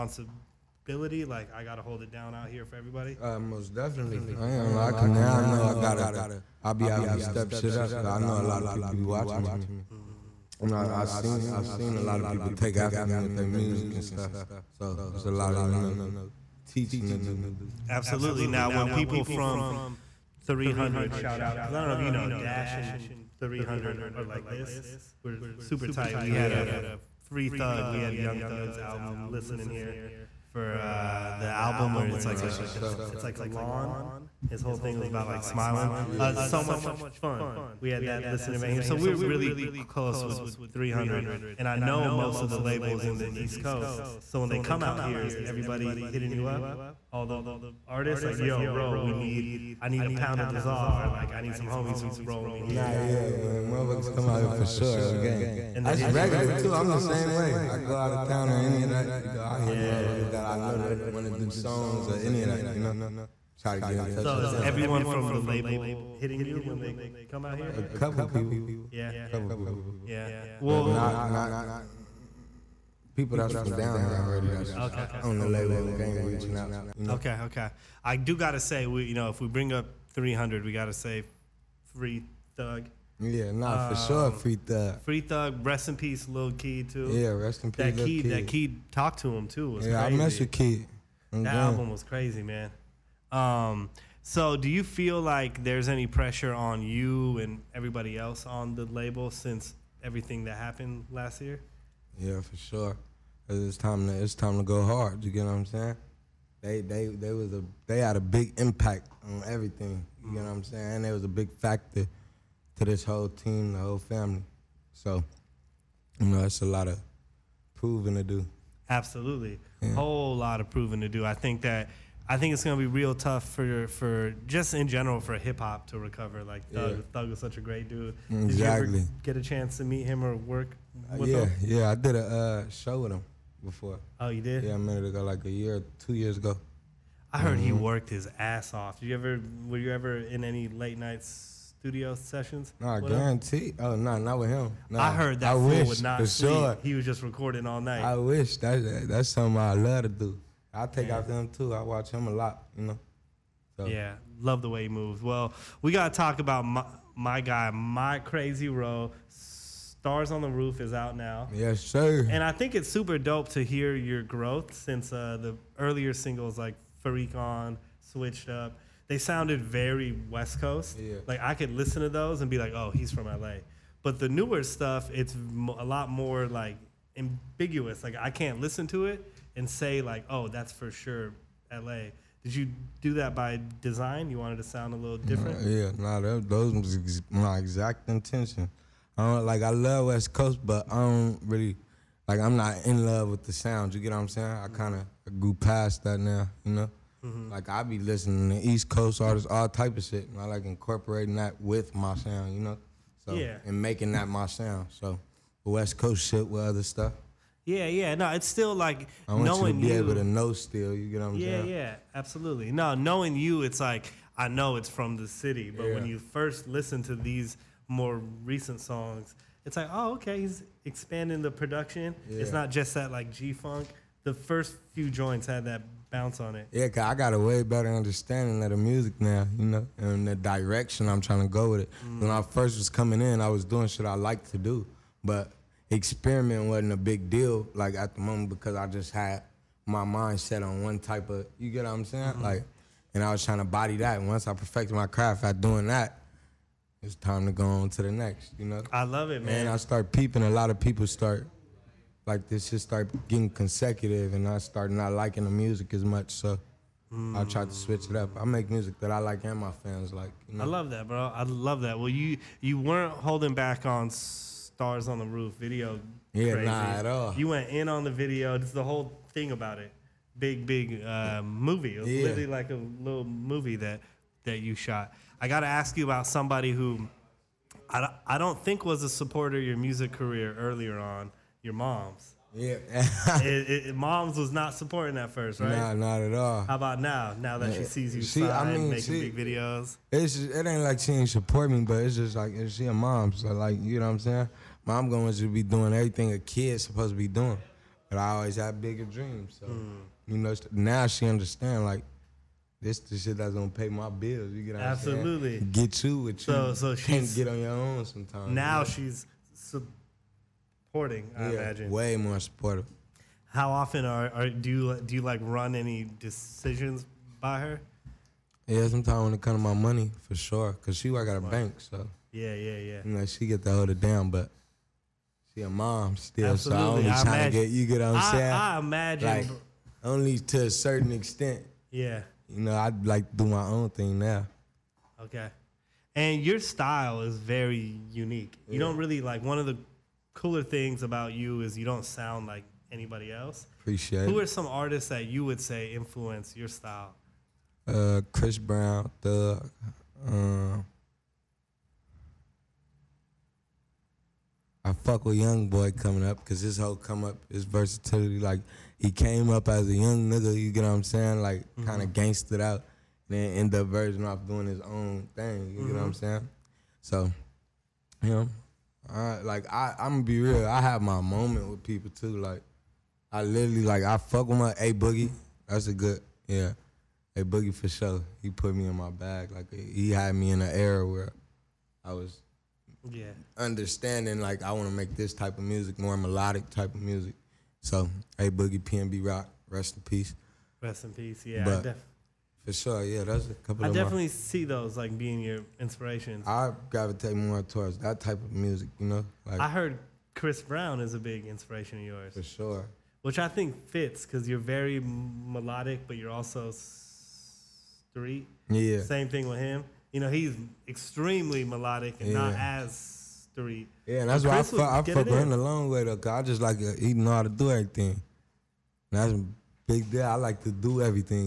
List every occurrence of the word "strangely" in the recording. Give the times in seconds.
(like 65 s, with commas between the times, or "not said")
not said.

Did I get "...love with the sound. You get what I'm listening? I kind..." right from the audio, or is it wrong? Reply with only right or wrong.
wrong.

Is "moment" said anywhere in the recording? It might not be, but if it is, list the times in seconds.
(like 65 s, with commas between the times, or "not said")
238 s, 371 s.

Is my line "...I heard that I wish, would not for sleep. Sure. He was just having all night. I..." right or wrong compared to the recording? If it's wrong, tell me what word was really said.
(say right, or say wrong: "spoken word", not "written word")
wrong: "recording", not "having".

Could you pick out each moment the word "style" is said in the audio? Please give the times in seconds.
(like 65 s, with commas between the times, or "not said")
336 s, 346 s.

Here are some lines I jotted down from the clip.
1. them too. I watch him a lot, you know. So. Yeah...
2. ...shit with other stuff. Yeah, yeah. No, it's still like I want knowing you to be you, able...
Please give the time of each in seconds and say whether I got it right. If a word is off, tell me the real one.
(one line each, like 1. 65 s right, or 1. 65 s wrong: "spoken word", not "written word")
1. 151 s right
2. 206 s right.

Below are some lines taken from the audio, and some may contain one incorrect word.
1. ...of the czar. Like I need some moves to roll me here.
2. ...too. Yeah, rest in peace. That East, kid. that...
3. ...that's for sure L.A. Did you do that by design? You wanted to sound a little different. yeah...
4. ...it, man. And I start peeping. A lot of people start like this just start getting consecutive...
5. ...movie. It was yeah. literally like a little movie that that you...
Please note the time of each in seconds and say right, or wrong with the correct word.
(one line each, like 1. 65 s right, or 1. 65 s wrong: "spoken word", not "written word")
1. 50 s wrong: "homies", not "moves"
2. 86 s wrong: "Kid", not "East"
3. 180 s right
4. 249 s right
5. 271 s right.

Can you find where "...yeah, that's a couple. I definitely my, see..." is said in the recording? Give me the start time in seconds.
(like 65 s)
393 s.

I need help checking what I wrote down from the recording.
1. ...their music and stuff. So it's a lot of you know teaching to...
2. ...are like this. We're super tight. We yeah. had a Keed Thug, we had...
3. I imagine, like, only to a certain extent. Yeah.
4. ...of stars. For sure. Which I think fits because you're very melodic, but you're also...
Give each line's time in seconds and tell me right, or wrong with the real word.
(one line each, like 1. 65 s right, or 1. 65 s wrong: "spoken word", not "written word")
1. 13 s right
2. 24 s wrong: "Free", not "Keed"
3. 328 s right
4. 401 s wrong: "yours", not "stars".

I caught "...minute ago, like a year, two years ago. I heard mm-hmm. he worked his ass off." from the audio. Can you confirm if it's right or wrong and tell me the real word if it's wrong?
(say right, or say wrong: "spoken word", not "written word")
right.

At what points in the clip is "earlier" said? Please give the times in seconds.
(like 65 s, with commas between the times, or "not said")
165 s, 280 s.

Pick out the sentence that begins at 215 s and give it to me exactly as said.
when you first listen to these more recent songs, it's like, oh, okay, he's expanding the production.